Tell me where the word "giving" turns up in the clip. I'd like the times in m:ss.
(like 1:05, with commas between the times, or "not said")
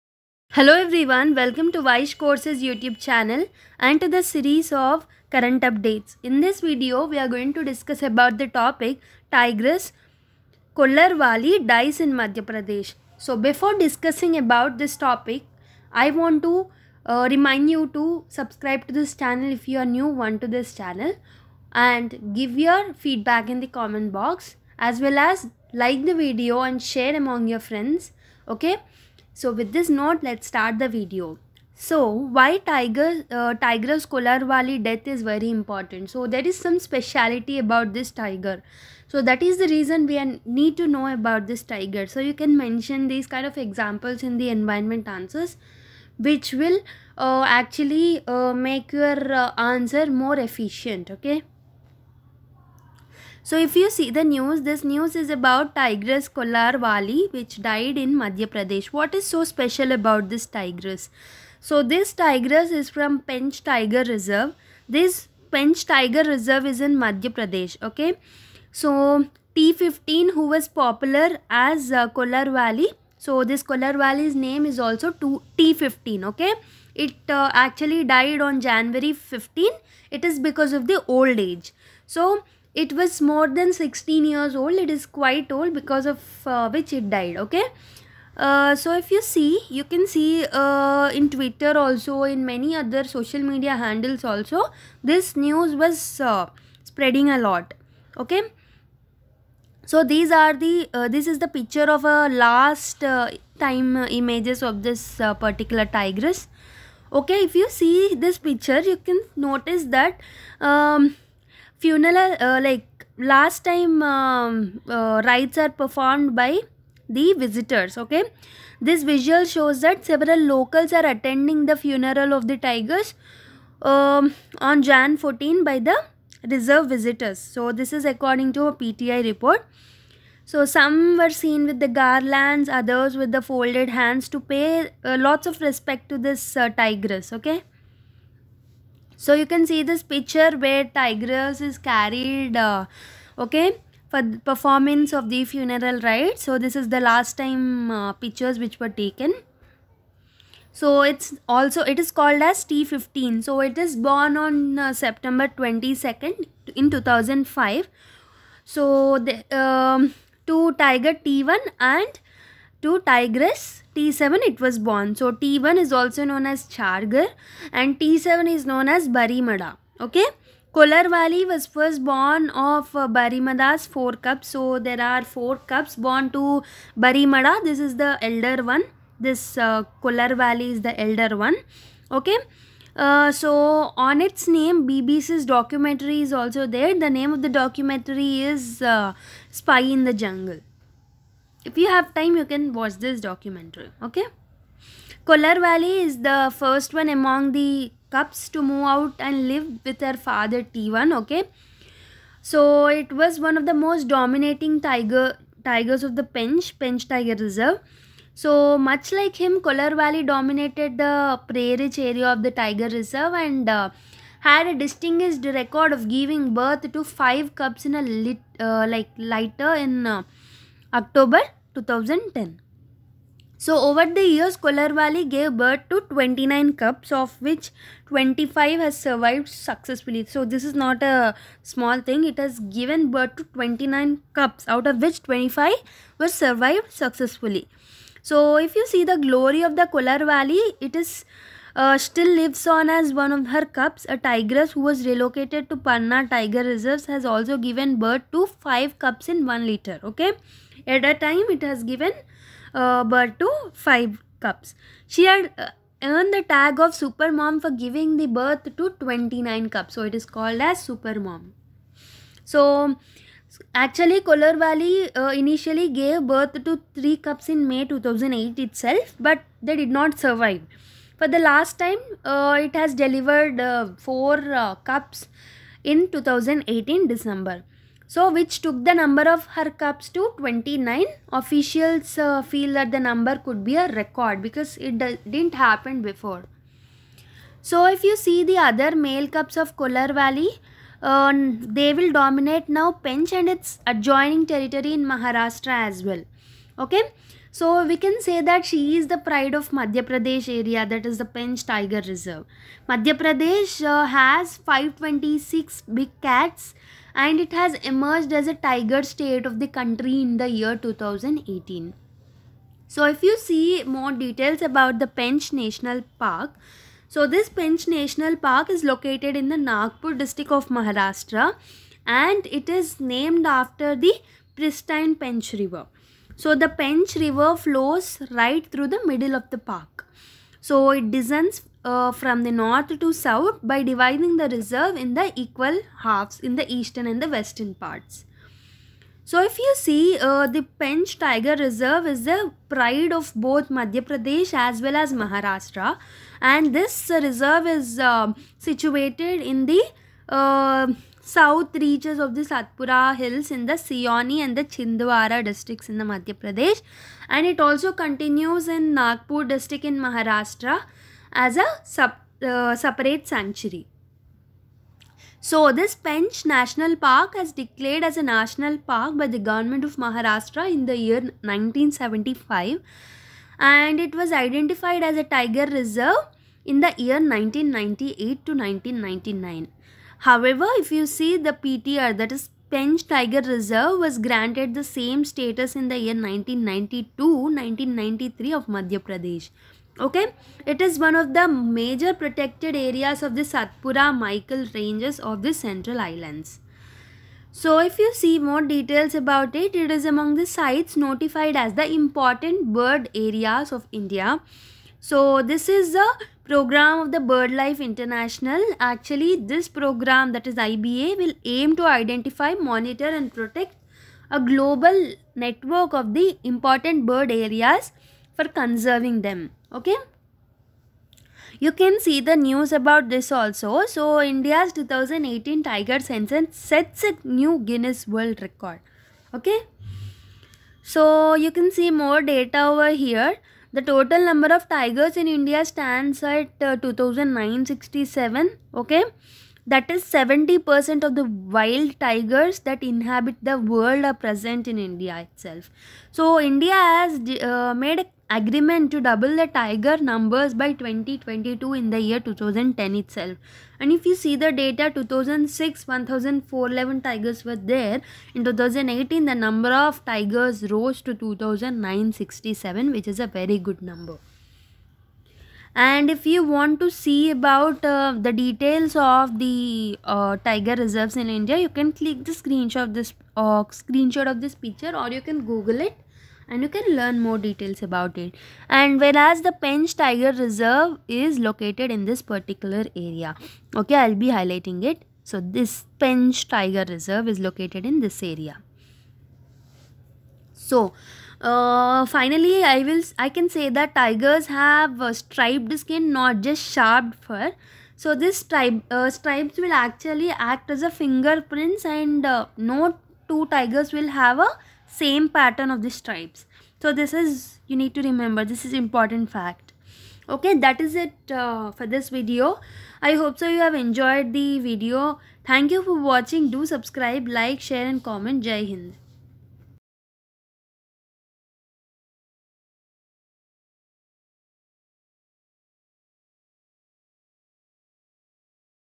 3:36, 4:17.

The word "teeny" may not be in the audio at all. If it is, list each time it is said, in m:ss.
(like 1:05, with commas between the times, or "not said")
not said.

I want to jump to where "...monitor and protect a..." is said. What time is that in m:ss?
6:52.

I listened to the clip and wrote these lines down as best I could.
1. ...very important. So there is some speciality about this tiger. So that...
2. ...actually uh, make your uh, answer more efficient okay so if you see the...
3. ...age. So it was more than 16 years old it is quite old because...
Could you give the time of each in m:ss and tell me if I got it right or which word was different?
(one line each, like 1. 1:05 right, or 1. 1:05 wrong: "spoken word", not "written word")
1. 0:35 right
2. 0:47 right
3. 1:21 right.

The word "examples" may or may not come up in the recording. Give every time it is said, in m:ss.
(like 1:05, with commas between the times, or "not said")
0:43.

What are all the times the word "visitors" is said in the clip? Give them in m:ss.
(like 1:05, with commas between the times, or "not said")
1:57, 2:06.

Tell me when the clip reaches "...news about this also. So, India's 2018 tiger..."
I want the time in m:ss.
7:02.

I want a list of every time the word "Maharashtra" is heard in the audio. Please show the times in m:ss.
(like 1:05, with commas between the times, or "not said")
4:55, 5:20, 5:45, 5:59, 6:09.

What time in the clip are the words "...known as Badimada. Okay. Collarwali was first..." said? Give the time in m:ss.
2:48.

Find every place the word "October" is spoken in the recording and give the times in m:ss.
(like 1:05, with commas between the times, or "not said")
3:40.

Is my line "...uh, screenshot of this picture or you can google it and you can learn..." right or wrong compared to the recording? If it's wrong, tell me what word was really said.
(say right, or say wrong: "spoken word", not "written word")
right.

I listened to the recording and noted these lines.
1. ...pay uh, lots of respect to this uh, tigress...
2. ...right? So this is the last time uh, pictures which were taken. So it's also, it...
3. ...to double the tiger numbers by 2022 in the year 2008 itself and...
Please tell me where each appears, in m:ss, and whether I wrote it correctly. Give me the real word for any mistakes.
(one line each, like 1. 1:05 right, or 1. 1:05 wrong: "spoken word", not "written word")
1. 2:14 right
2. 2:26 right
3. 7:28 wrong: "2010", not "2008".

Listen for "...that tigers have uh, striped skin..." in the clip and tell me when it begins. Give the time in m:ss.
8:13.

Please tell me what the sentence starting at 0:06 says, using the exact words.
In this video, we are going to discuss about the topic Tigris Kollar dies in Madhya Pradesh.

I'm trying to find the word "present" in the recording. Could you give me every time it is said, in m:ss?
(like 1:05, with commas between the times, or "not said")
7:24.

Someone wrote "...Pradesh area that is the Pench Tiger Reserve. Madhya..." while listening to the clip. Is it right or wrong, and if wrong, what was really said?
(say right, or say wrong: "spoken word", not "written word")
right.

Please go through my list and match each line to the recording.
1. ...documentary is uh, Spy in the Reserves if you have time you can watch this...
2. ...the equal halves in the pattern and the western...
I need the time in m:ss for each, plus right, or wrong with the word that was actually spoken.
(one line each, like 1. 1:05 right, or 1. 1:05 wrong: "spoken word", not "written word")
1. 3:07 wrong: "Jungle", not "Reserves"
2. 5:35 wrong: "eastern", not "pattern".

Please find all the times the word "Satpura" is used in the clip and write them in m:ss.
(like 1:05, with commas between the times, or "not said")
5:52, 6:33.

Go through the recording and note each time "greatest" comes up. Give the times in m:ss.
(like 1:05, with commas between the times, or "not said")
not said.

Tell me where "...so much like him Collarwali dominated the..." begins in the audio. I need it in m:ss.
3:28.